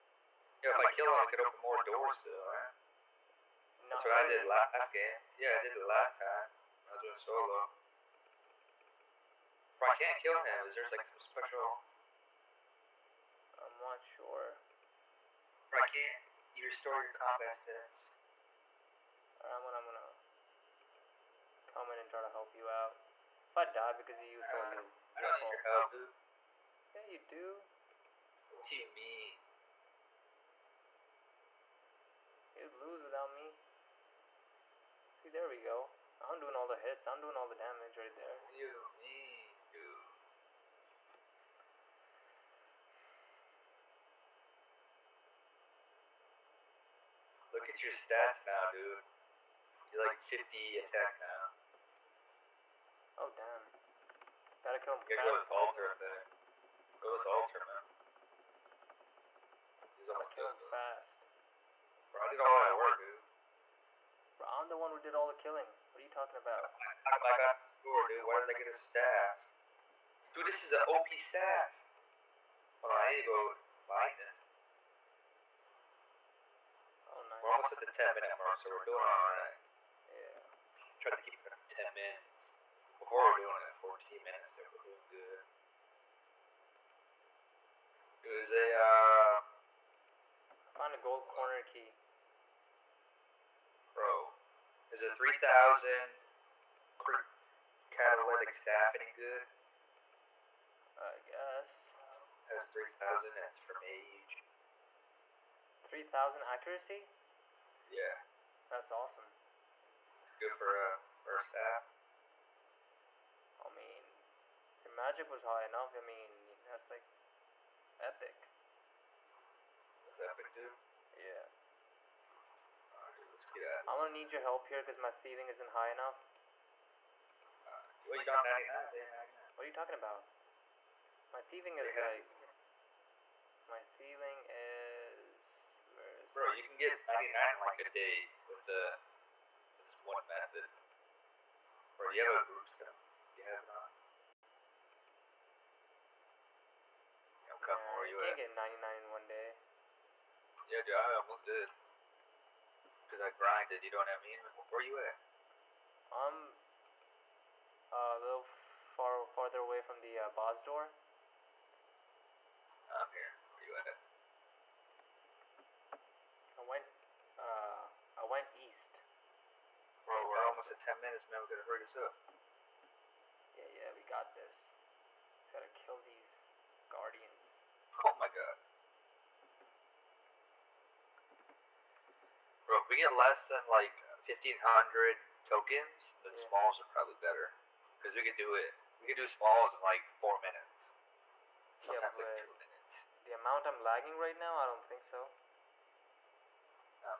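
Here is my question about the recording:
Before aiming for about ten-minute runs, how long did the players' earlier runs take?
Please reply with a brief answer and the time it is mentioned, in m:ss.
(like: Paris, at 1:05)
14 minutes, at 1:23.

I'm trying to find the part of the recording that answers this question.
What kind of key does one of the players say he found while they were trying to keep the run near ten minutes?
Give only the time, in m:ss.
1:30.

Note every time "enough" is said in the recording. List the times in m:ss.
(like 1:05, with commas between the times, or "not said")
1:55, 2:05.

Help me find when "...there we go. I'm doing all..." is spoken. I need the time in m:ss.
0:35.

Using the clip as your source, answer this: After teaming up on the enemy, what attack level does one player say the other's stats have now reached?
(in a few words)
50.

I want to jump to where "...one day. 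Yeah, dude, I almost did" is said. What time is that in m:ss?
2:29.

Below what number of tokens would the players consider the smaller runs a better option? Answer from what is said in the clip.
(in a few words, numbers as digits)
1,500.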